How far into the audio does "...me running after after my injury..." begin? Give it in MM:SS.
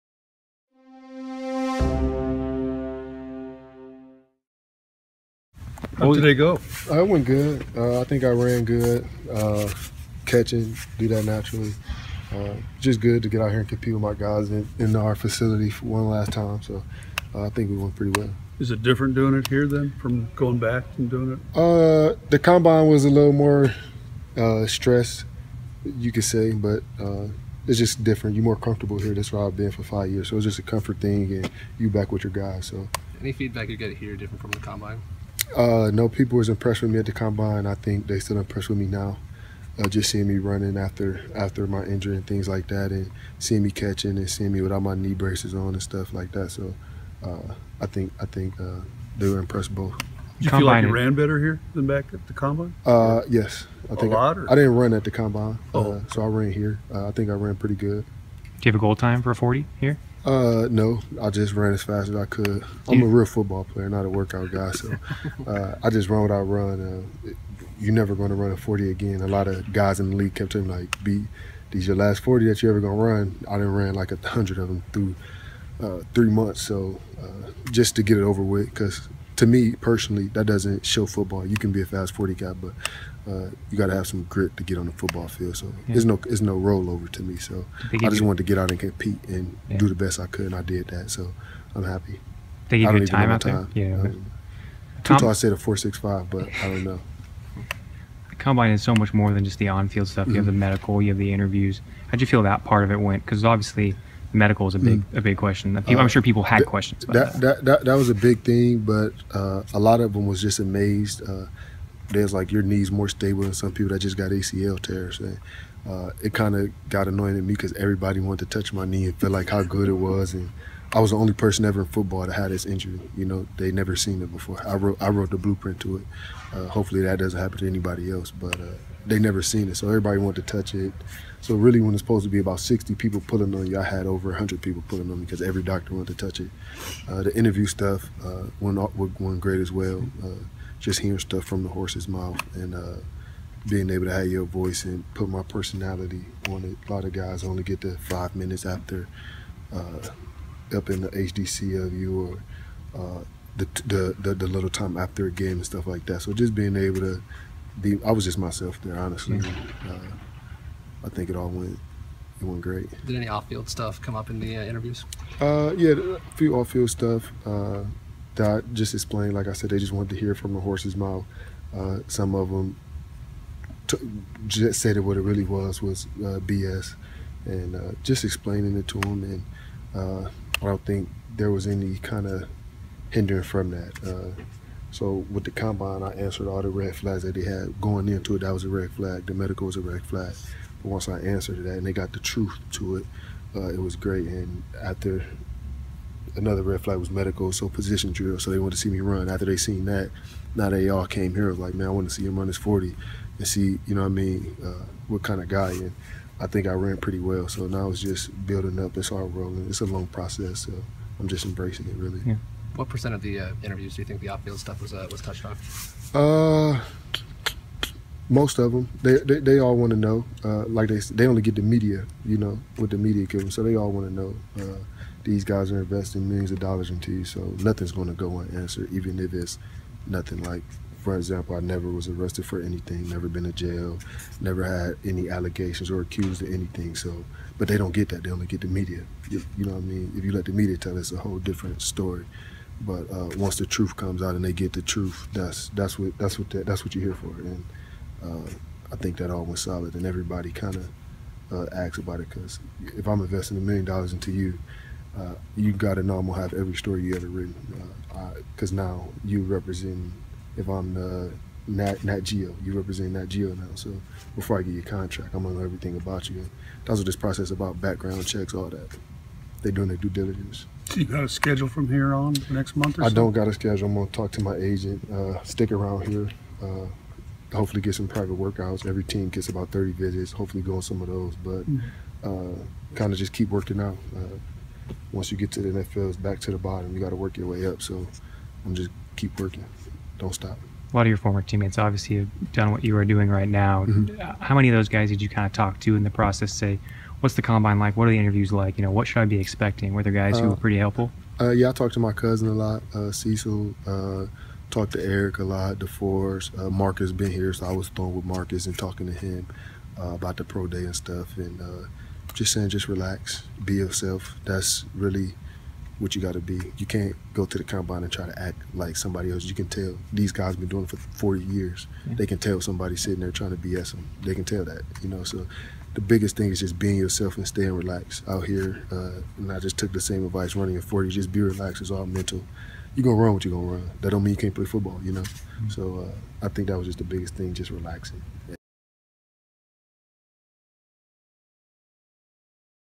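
00:40.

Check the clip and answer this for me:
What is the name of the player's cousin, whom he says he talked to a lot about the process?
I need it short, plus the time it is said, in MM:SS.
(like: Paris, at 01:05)
Cecil, at 05:03.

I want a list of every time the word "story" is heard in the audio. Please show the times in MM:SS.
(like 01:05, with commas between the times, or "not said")
04:01, 04:16.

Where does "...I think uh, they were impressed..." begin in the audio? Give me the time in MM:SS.
00:48.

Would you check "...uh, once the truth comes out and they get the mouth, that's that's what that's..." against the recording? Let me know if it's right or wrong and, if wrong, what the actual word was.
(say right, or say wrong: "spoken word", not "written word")
wrong: "truth", not "mouth".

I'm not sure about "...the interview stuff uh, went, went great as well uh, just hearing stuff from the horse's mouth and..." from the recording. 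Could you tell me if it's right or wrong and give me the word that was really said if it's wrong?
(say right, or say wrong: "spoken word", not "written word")
right.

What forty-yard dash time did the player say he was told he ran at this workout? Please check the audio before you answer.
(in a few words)
4.65.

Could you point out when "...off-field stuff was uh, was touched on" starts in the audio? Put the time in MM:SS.
03:34.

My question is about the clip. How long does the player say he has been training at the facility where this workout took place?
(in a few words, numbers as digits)
5 years.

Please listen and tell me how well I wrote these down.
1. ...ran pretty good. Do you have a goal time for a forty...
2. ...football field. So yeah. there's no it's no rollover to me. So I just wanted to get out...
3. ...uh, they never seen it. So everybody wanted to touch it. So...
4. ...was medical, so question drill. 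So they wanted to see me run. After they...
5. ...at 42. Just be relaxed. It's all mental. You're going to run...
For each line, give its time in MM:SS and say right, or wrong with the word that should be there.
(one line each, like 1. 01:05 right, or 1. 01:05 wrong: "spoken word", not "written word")
1. 00:57 right
2. 01:24 right
3. 02:08 right
4. 03:16 wrong: "position", not "question"
5. 05:30 wrong: "40", not "42".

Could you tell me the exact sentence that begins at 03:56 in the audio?
So, but they don't get that; they only get the media.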